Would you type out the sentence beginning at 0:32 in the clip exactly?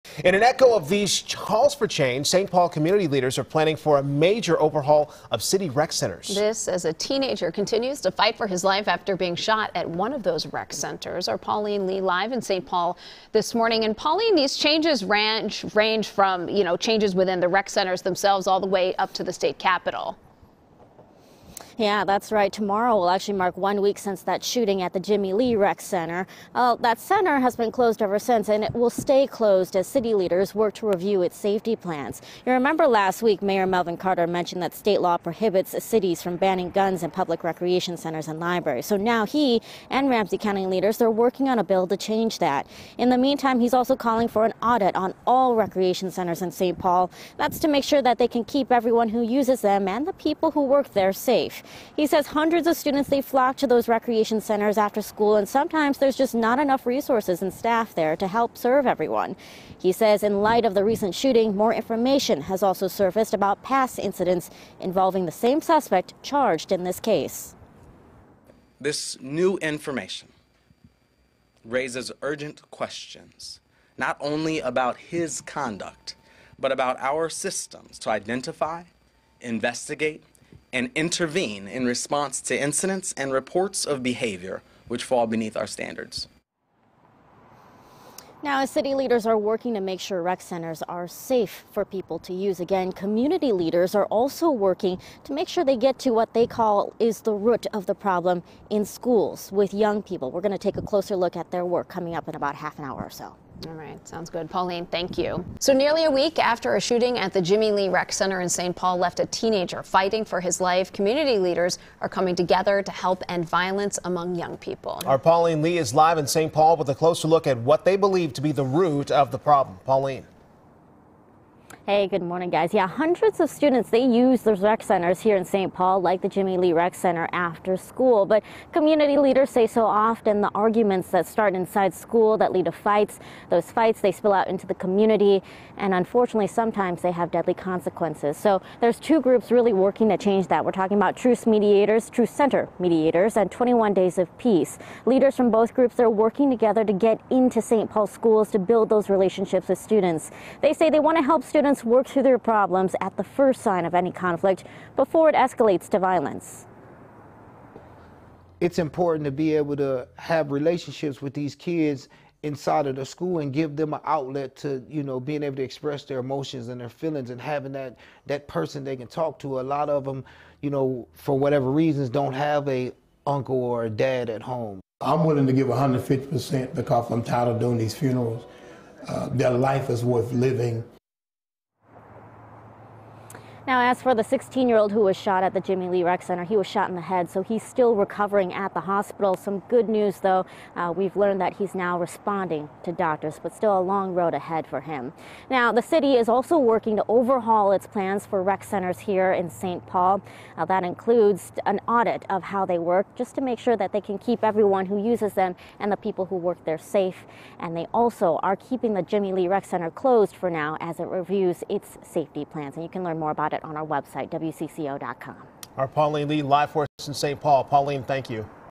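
You remember last week, Mayor Melvin Carter mentioned that state law prohibits cities from banning guns in public recreation centers and libraries.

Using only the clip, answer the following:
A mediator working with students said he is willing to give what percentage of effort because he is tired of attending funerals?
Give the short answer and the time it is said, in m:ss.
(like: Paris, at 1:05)
150%, at 2:55.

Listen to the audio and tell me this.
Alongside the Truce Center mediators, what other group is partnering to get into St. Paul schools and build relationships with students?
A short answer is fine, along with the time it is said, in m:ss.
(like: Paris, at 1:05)
21 Days of Peace, at 2:23.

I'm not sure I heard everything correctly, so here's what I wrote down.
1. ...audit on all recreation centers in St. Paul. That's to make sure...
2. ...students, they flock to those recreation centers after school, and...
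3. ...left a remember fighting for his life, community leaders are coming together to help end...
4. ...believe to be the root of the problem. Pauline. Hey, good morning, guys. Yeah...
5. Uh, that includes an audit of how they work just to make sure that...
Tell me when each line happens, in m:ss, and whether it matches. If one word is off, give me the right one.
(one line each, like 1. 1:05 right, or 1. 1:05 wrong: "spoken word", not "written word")
1. 0:44 right
2. 0:52 right
3. 1:48 wrong: "teenager", not "remember"
4. 1:57 right
5. 3:20 right.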